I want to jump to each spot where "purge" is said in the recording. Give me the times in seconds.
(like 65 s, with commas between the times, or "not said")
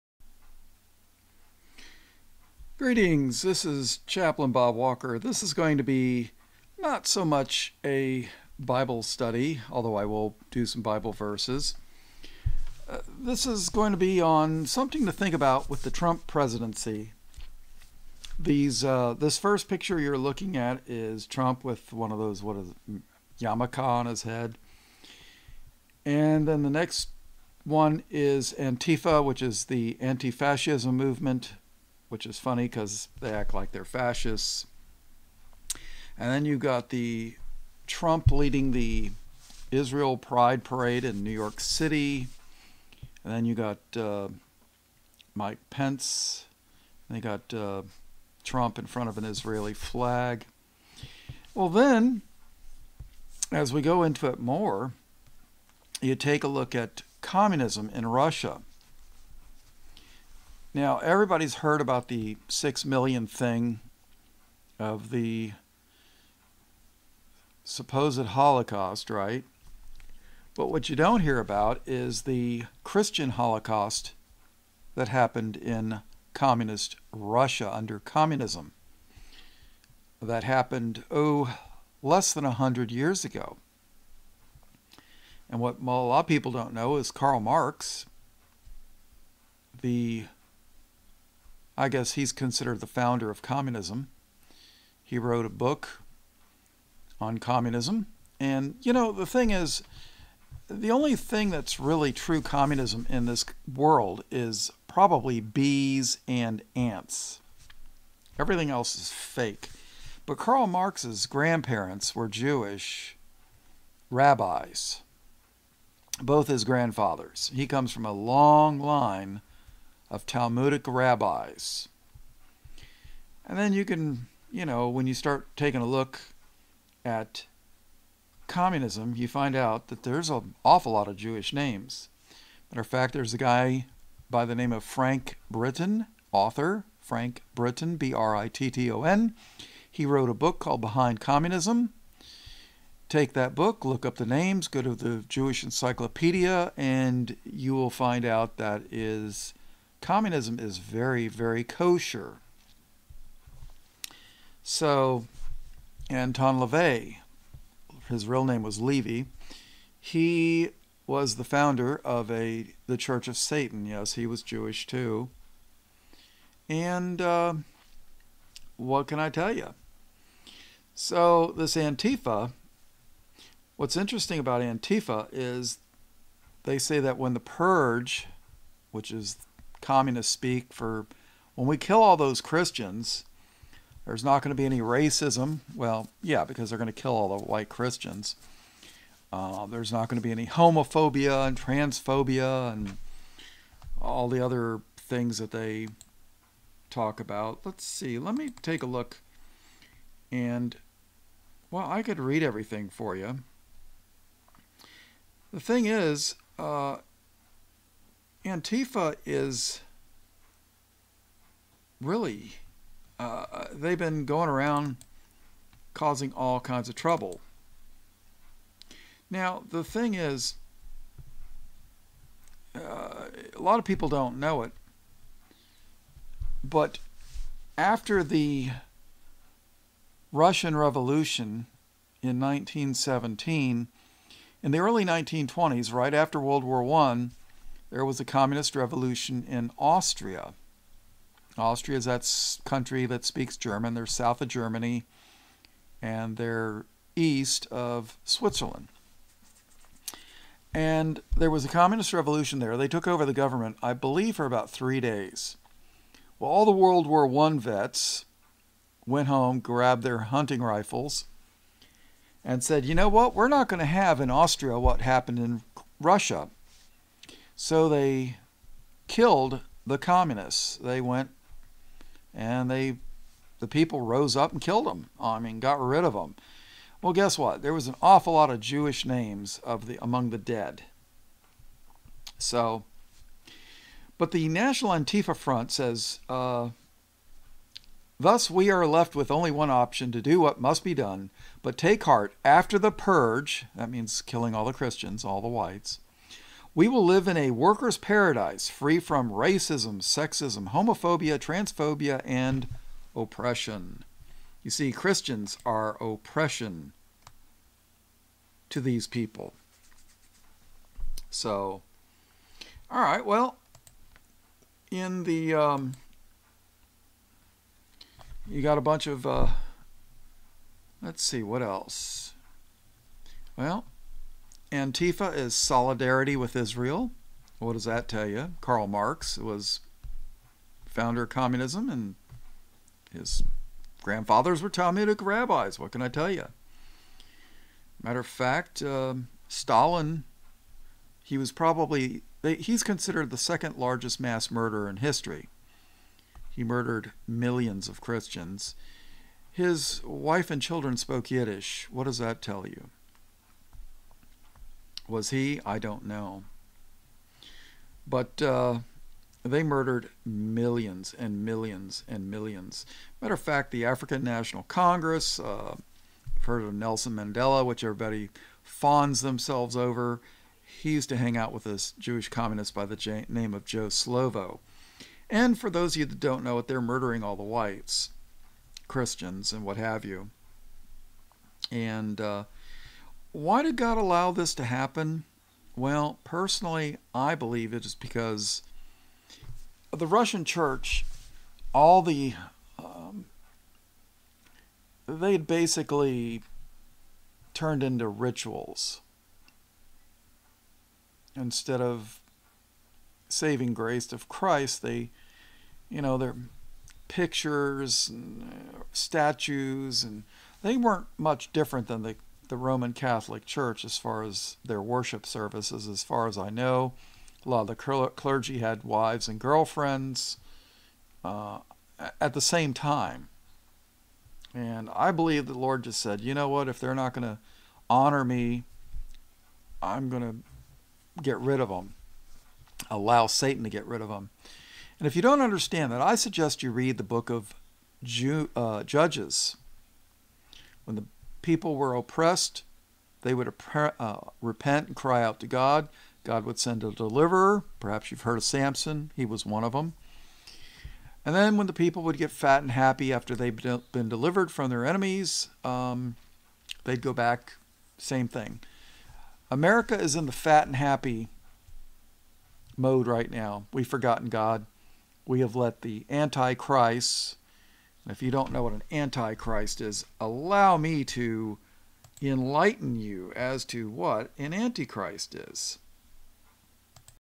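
177 s, 292 s.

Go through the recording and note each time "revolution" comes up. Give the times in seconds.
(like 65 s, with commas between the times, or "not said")
230 s, 238 s, 252 s.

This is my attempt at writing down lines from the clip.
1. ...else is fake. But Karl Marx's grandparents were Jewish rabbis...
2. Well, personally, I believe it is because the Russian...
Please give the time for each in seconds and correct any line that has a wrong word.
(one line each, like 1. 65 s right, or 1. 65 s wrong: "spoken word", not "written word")
1. 108 s right
2. 385 s right.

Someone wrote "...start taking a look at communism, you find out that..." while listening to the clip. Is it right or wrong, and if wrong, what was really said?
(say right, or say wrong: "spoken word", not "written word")
right.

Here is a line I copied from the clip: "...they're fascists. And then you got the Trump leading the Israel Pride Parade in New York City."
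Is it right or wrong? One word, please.
right.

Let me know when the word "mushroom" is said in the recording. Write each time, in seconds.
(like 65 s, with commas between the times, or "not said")
not said.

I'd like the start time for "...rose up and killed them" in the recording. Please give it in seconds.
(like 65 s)
274 s.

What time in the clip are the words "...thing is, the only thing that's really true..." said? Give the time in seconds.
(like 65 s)
99 s.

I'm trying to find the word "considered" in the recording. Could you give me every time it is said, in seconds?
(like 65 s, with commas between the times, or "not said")
92 s, 342 s.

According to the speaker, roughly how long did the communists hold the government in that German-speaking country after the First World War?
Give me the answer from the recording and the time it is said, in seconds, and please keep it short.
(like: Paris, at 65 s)
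about 3 days, at 254 s.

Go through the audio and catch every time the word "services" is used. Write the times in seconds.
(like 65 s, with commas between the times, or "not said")
415 s.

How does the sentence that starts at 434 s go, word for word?
And if you don't understand that, I suggest you read the book of Ju- uh, Judges.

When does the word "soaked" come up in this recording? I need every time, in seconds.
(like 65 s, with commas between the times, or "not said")
not said.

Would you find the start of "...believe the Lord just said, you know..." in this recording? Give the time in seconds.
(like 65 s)
425 s.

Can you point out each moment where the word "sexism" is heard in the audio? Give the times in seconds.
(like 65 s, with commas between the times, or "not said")
300 s.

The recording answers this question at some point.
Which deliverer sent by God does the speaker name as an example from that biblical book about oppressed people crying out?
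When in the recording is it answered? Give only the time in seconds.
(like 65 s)
448 s.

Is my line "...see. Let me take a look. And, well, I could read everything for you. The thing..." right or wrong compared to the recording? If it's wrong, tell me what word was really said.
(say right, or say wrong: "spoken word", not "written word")
right.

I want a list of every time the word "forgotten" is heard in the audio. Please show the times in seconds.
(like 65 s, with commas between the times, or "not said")
463 s.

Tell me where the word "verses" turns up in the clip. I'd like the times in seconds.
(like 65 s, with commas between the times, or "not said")
11 s.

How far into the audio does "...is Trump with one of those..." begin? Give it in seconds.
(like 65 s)
20 s.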